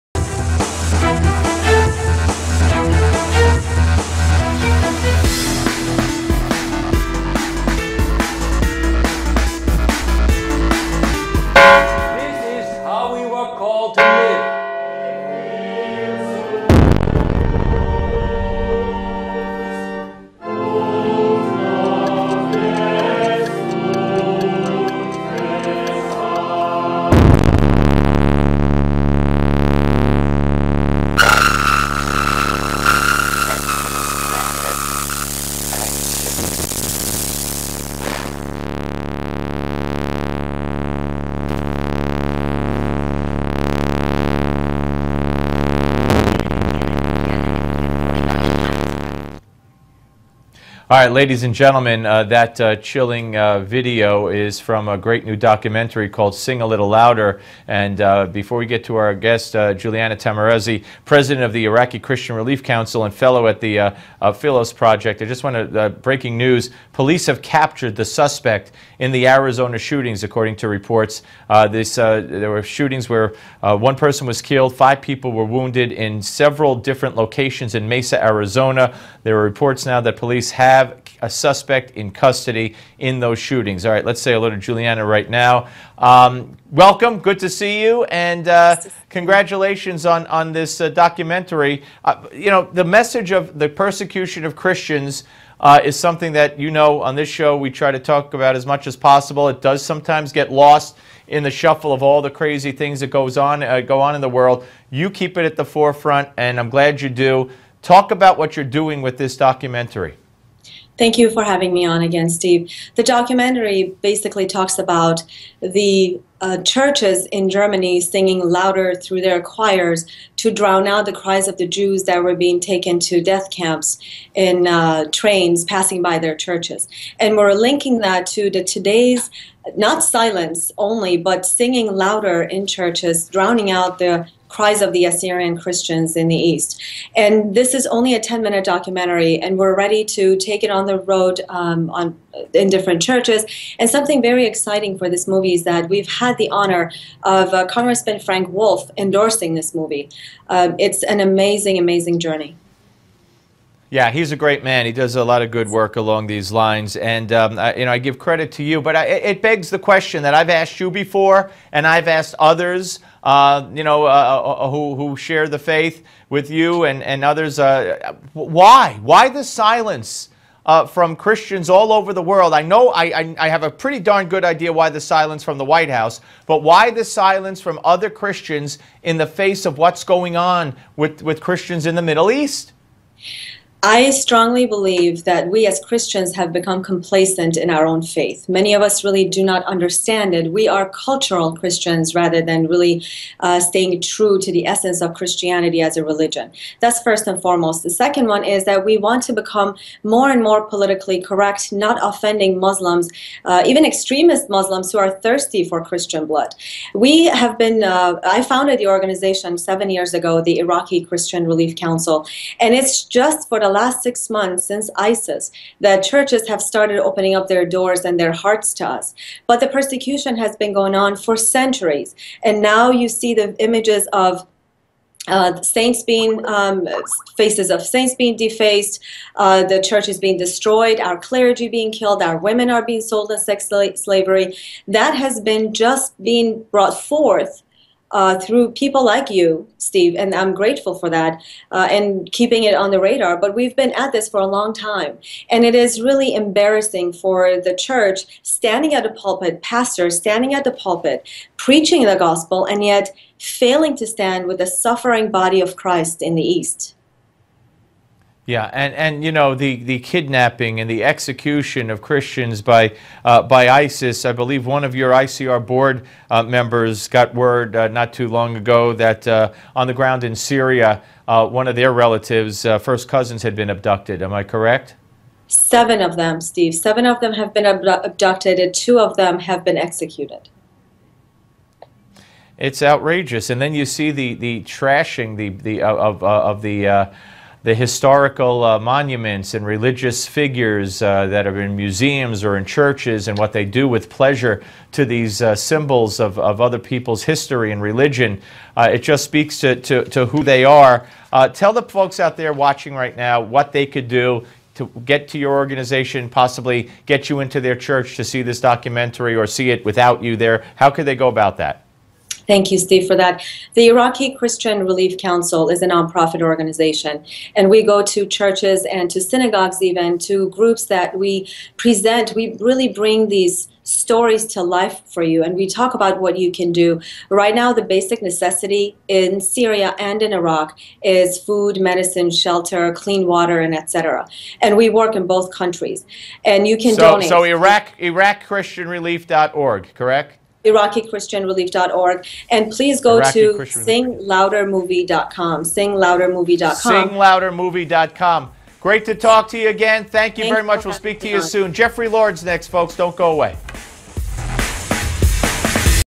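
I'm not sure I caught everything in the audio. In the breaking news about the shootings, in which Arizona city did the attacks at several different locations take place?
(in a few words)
Mesa.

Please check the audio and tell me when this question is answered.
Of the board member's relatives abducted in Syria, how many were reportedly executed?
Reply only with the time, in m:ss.
4:38.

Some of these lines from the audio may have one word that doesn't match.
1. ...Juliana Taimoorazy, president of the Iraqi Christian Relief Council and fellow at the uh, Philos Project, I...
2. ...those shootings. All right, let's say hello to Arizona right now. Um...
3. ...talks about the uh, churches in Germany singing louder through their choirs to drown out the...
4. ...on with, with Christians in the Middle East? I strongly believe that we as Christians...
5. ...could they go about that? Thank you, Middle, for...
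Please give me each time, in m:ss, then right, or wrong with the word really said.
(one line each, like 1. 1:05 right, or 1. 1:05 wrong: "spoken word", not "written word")
1. 0:59 right
2. 1:23 wrong: "Juliana", not "Arizona"
3. 1:54 right
4. 3:00 right
5. 5:10 wrong: "Steve", not "Middle".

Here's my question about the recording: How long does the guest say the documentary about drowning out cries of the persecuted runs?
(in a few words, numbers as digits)
10 minutes.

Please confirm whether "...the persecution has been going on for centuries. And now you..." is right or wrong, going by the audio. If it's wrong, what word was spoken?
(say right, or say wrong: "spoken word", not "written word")
right.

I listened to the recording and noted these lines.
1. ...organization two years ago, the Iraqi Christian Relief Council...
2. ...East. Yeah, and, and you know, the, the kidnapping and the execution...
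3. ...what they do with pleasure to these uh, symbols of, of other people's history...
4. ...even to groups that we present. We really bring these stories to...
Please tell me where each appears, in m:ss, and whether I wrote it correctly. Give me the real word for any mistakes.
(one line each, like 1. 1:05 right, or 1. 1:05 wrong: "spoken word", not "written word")
1. 3:28 wrong: "seven", not "two"
2. 4:16 right
3. 4:53 right
4. 5:19 right.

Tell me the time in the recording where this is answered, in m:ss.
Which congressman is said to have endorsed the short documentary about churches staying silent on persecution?
2:28.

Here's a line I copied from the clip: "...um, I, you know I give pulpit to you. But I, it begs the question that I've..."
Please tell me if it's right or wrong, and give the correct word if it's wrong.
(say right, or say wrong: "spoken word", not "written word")
wrong: "credit", not "pulpit".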